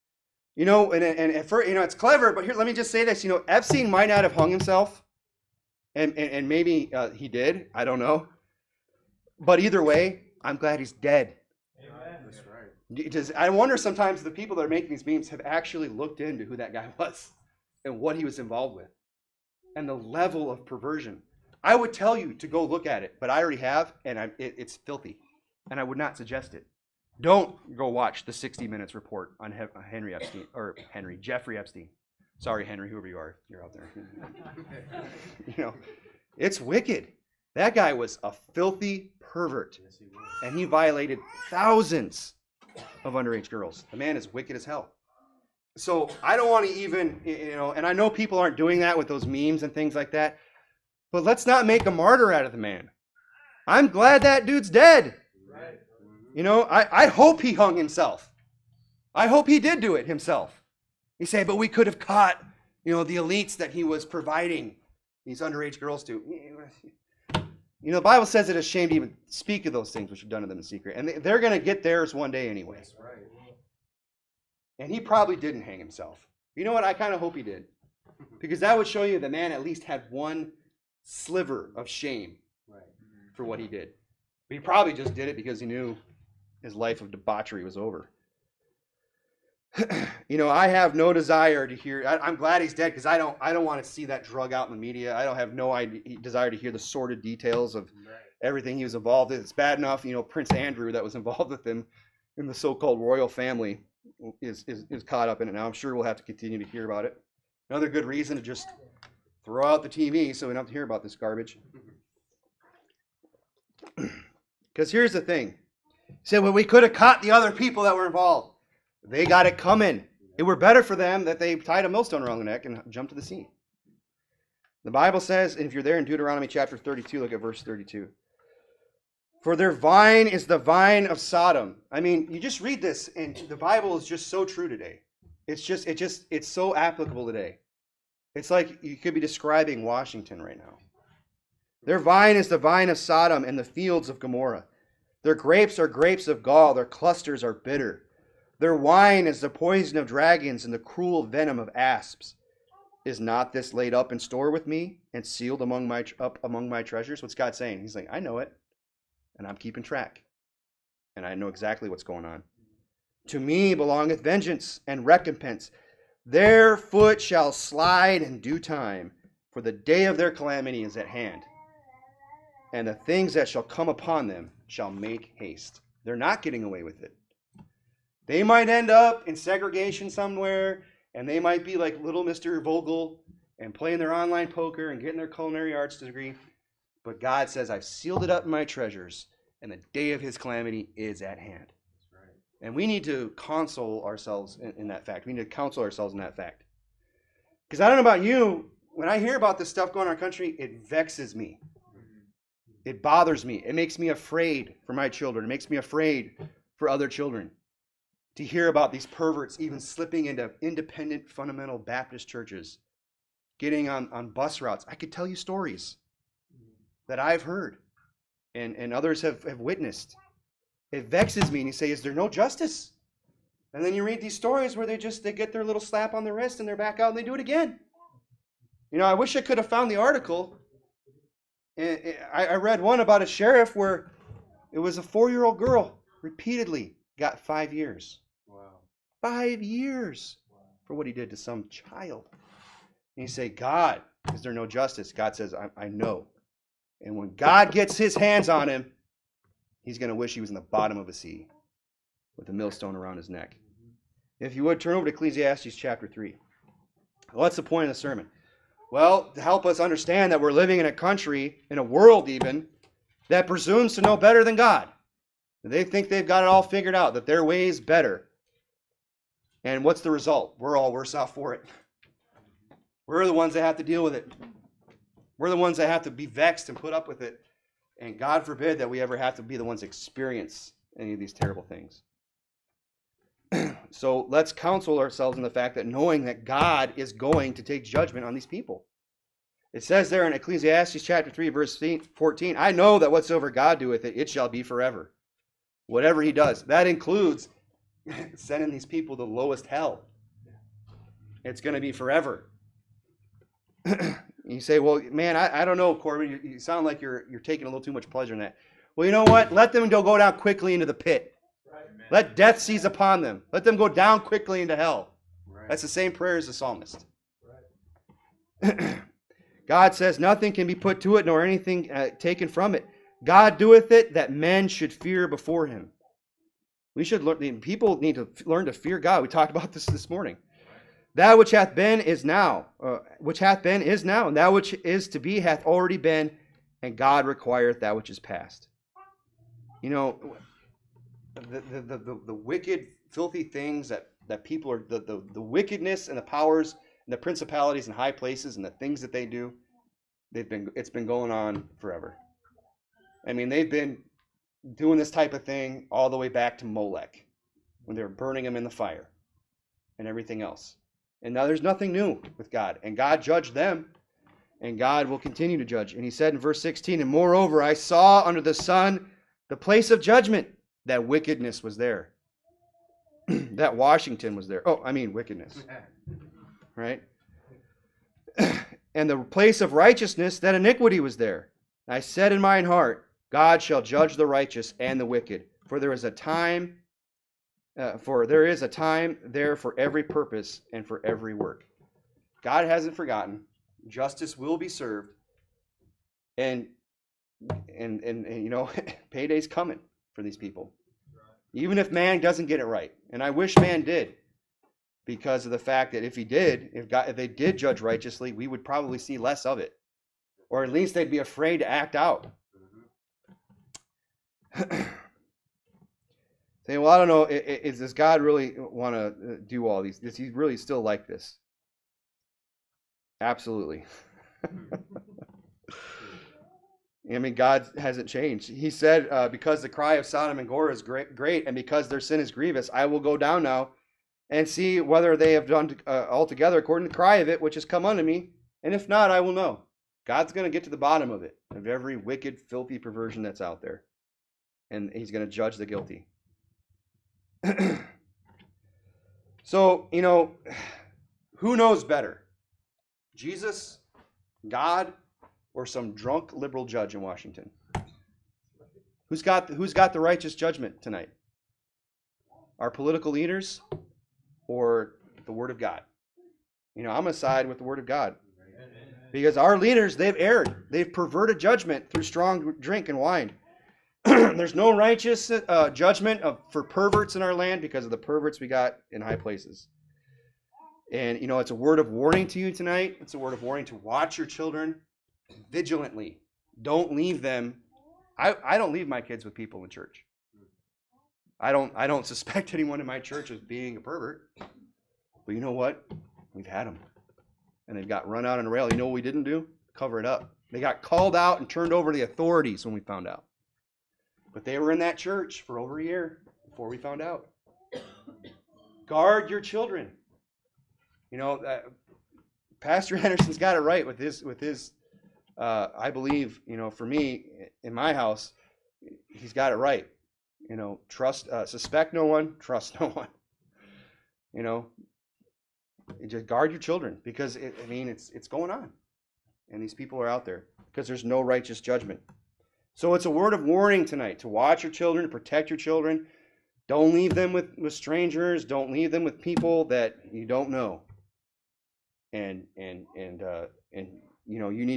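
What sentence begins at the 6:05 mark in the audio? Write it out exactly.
And he said in verse 16, And moreover, I saw under the sun the place of judgment, that wickedness was there.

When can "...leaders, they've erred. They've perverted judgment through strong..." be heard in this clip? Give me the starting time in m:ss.
7:49.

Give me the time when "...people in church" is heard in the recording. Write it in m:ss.
8:09.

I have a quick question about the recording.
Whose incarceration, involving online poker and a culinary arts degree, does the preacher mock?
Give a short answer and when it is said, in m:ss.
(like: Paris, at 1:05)
Mr. Fogle, at 3:02.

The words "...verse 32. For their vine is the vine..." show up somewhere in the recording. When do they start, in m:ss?
2:07.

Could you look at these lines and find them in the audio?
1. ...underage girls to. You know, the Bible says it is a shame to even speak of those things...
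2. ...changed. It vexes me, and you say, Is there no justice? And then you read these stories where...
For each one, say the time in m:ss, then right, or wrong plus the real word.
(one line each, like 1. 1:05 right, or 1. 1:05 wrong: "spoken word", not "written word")
1. 1:05 right
2. 3:39 wrong: "witnessed", not "changed".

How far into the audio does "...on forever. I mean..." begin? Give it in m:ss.
5:51.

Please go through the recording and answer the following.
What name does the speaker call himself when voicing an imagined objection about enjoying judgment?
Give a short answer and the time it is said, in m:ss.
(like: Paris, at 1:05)
Corbin, at 5:05.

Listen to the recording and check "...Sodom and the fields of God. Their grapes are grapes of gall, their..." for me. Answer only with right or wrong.
wrong.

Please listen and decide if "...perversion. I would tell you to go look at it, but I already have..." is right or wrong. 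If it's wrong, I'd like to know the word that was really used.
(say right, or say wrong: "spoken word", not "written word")
right.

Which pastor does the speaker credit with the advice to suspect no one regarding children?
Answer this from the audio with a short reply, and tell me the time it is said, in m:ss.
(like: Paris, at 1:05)
Pastor Anderson, at 8:32.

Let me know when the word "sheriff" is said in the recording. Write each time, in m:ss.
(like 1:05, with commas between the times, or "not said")
3:53.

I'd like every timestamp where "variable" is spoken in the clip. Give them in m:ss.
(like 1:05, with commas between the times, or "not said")
not said.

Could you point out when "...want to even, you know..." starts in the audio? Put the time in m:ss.
0:46.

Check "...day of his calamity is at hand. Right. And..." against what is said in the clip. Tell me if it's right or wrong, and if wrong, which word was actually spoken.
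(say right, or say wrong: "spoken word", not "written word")
right.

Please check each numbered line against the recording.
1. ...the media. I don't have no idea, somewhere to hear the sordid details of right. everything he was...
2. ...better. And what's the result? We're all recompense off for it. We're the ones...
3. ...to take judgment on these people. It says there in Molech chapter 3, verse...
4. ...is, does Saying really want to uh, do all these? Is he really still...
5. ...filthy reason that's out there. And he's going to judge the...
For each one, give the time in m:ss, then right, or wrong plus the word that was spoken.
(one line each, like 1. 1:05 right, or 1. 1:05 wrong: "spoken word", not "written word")
1. 1:34 wrong: "desire", not "somewhere"
2. 4:27 wrong: "worse", not "recompense"
3. 4:47 wrong: "Ecclesiastes", not "Molech"
4. 6:57 wrong: "God", not "Saying"
5. 7:22 wrong: "perversion", not "reason".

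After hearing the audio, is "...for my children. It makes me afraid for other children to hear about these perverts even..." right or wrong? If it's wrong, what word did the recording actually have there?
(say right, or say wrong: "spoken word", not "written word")
right.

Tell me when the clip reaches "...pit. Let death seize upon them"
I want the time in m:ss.
5:10.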